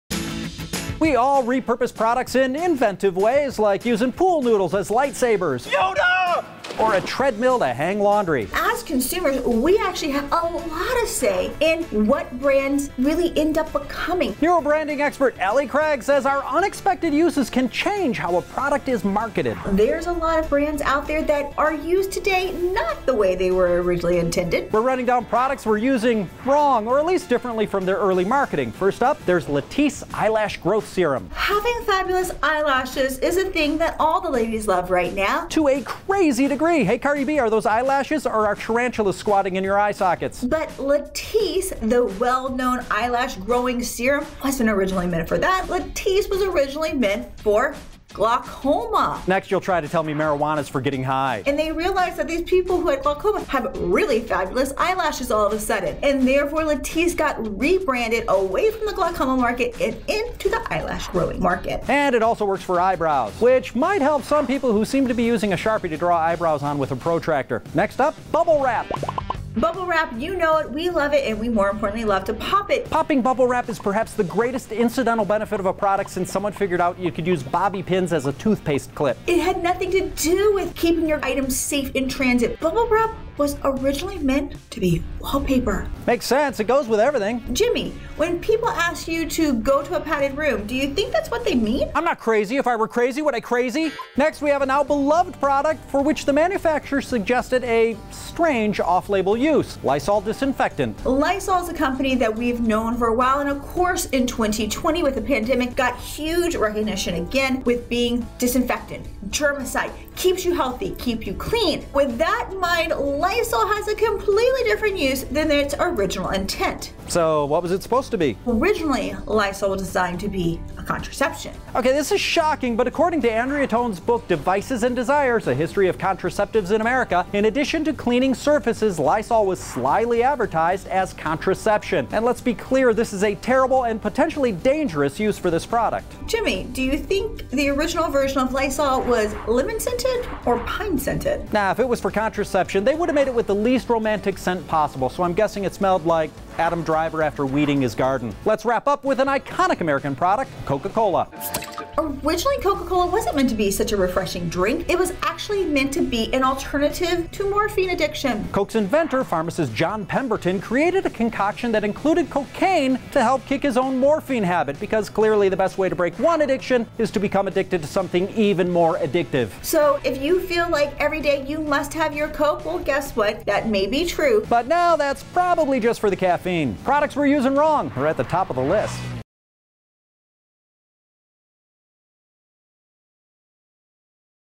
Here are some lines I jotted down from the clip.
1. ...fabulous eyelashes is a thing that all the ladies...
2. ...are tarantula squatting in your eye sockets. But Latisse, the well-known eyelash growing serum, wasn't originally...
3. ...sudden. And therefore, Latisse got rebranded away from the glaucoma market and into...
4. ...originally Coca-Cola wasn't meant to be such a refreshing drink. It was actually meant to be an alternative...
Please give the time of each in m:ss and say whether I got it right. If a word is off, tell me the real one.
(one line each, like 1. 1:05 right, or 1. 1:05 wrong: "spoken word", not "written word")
1. 0:31 right
2. 0:38 right
3. 0:55 right
4. 2:31 right.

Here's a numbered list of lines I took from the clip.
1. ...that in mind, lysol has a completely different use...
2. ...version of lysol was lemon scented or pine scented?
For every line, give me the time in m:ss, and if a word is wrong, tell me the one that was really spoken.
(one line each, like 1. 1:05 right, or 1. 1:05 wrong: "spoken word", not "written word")
1. 1:52 right
2. 2:18 right.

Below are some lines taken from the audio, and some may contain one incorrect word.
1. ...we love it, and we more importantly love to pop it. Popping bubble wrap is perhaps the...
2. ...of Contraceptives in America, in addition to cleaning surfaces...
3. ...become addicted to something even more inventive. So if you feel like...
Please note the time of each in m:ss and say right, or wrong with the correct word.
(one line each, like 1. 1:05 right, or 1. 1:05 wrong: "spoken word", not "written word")
1. 1:10 right
2. 2:05 right
3. 2:47 wrong: "addictive", not "inventive".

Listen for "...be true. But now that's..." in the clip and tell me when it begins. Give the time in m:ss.
2:53.